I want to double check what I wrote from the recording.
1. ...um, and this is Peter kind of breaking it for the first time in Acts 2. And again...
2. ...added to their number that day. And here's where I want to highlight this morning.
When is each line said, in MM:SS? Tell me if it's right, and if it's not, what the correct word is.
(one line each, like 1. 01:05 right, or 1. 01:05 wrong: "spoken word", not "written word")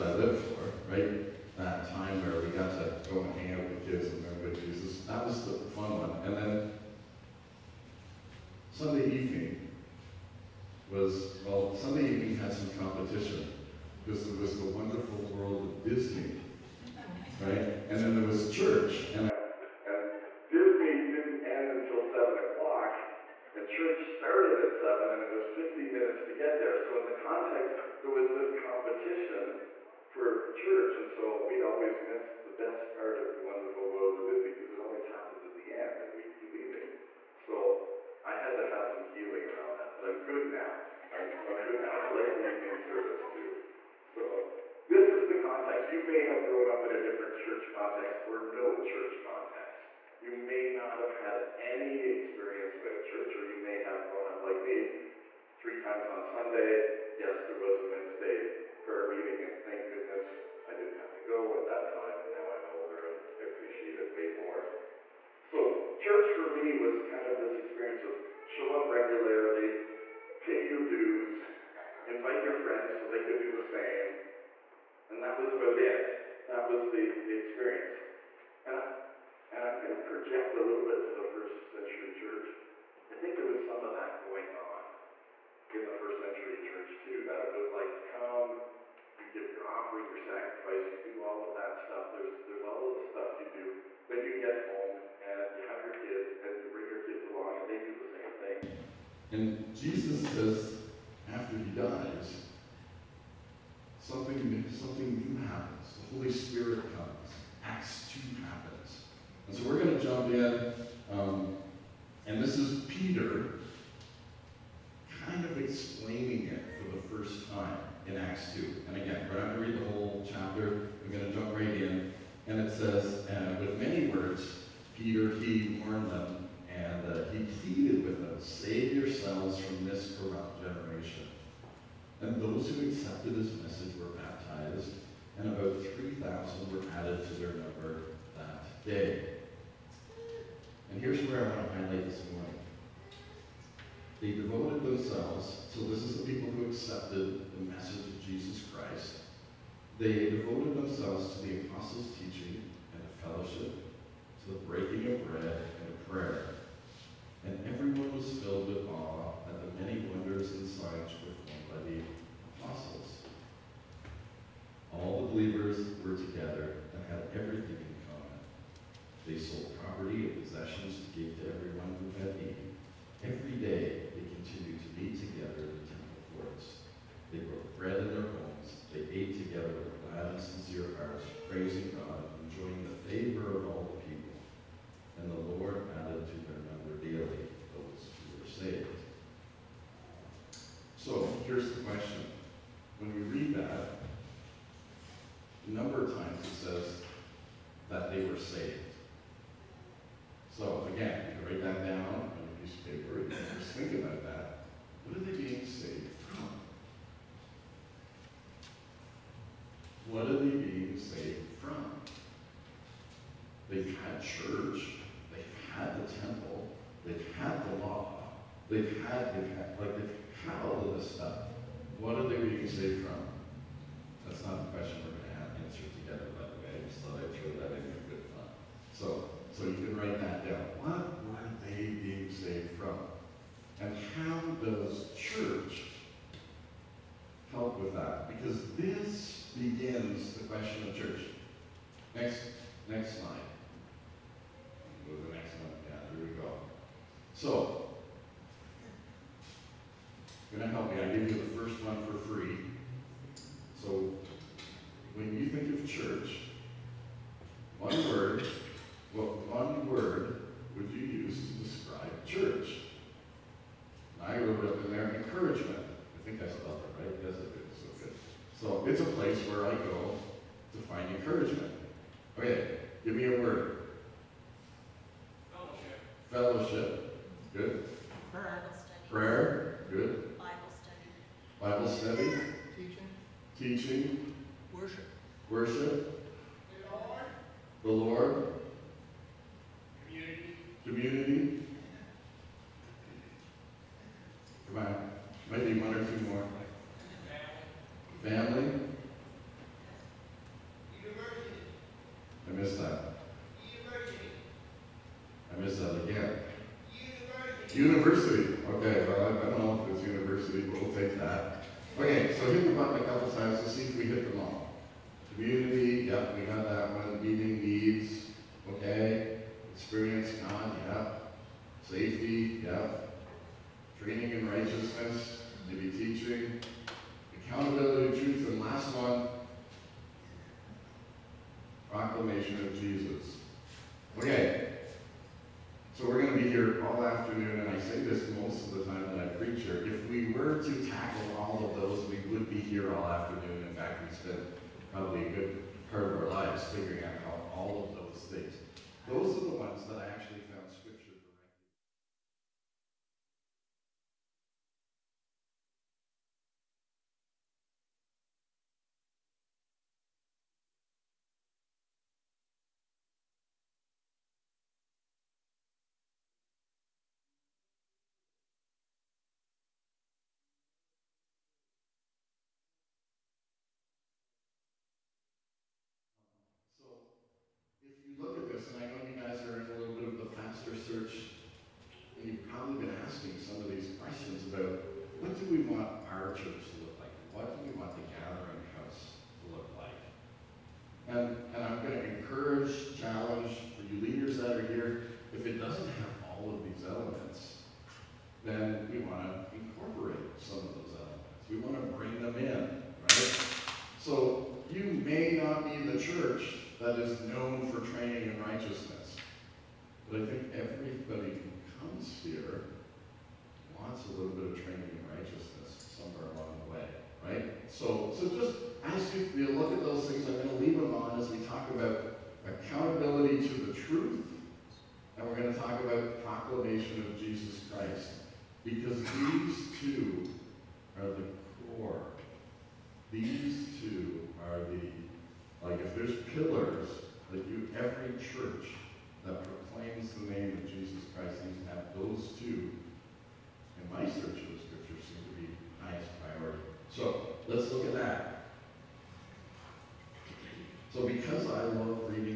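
1. 01:51 wrong: "explaining", not "breaking"
2. 02:16 right.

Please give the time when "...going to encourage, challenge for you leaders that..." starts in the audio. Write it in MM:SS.
06:31.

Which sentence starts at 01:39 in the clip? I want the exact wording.
And Jesus says, after he dies, something, something new happens.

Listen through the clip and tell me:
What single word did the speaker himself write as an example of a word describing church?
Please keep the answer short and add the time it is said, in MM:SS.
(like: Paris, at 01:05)
Encouragement, at 04:25.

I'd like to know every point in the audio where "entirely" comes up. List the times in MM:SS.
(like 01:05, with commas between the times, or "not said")
not said.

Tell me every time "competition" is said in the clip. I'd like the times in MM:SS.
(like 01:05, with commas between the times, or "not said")
00:12, 00:28.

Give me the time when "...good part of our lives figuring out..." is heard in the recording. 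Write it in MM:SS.
05:45.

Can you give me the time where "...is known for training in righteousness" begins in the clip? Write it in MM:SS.
06:46.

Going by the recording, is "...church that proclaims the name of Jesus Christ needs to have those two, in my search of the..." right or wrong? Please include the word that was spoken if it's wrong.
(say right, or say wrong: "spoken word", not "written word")
right.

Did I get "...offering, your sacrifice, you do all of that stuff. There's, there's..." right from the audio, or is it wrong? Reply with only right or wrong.
right.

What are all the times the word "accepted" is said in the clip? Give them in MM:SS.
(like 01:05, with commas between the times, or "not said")
02:12, 02:26.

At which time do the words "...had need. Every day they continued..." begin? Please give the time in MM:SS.
02:52.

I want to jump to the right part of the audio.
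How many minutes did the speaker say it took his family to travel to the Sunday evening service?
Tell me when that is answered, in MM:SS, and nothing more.
00:25.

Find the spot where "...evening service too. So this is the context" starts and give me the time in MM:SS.
00:42.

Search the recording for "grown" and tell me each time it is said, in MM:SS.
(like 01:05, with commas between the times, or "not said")
00:46, 00:54.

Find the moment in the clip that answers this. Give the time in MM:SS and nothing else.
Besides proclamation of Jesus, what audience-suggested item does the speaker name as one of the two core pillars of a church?
07:02.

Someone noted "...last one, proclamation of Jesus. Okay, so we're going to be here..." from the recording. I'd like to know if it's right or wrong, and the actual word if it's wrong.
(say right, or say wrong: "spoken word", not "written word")
right.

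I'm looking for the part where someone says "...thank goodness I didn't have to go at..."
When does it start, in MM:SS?
00:59.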